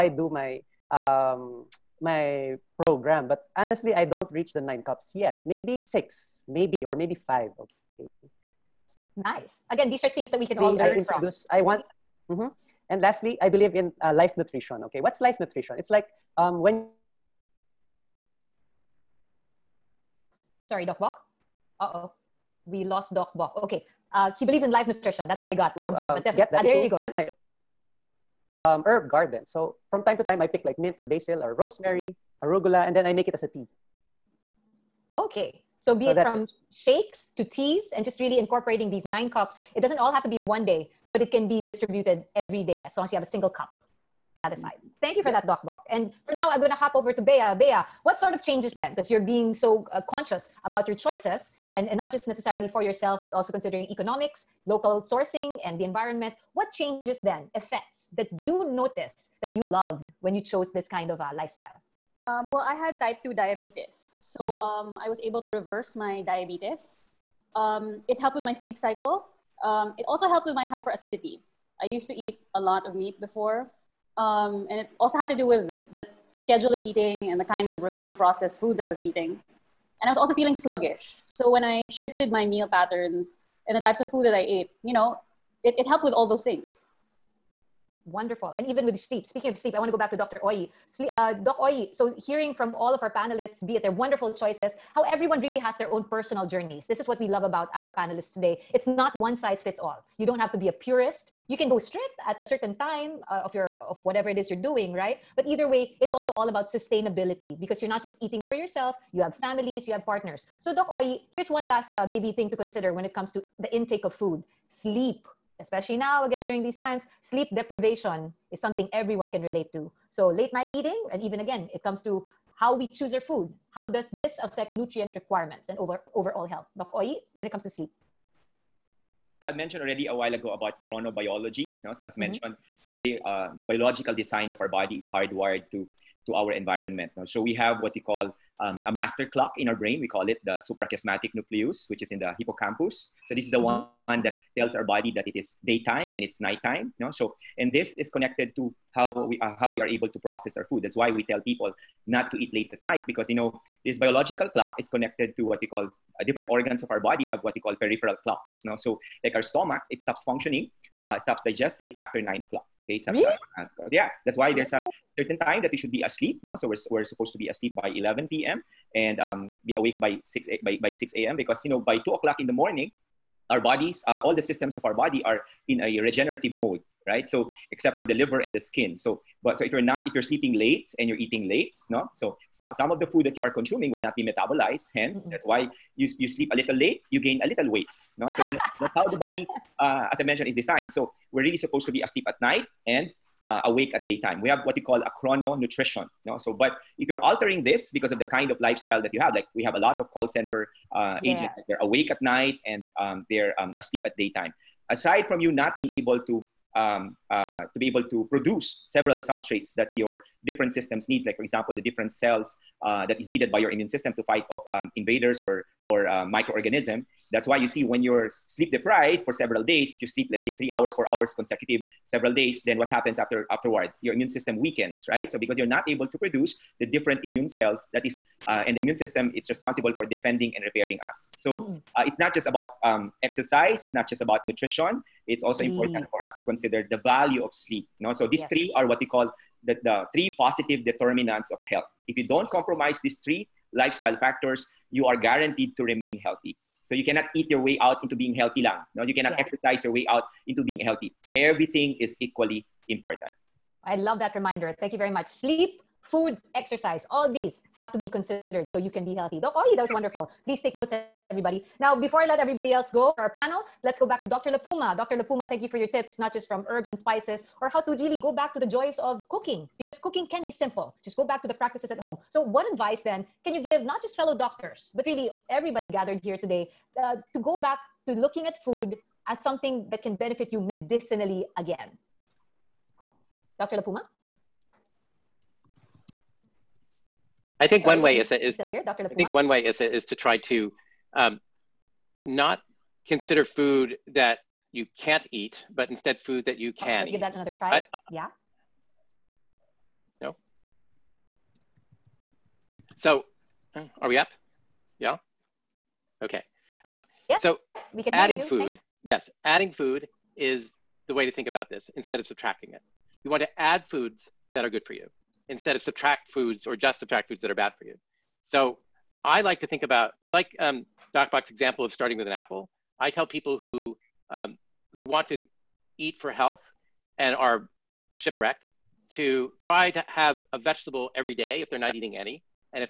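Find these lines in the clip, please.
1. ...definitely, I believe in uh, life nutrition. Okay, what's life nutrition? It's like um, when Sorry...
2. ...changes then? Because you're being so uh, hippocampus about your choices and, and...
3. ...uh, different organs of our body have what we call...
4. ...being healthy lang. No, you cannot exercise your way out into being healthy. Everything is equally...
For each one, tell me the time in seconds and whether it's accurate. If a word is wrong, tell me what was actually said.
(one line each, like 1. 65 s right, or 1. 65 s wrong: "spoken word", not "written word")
1. 13 s wrong: "lastly", not "definitely"
2. 48 s wrong: "conscious", not "hippocampus"
3. 156 s right
4. 248 s right.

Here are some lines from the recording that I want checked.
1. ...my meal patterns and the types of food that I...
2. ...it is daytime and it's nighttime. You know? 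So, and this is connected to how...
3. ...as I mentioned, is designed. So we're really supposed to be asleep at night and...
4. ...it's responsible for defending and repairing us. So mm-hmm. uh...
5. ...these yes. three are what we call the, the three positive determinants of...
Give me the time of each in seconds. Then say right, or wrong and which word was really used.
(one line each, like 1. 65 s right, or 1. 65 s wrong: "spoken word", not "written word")
1. 82 s right
2. 145 s right
3. 190 s right
4. 229 s right
5. 238 s right.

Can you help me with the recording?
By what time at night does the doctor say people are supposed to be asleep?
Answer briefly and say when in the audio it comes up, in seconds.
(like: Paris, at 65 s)
11 p.m., at 167 s.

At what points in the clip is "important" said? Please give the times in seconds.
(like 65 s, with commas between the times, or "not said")
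235 s, 252 s.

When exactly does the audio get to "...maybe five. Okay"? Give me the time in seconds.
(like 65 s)
6 s.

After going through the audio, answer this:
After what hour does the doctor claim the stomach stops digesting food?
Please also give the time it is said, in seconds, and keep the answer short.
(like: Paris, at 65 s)
9 o'clock, at 162 s.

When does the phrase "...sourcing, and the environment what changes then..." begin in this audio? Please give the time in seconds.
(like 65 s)
55 s.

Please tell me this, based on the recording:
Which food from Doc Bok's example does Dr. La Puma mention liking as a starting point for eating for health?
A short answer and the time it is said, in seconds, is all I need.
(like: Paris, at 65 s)
An apple, at 322 s.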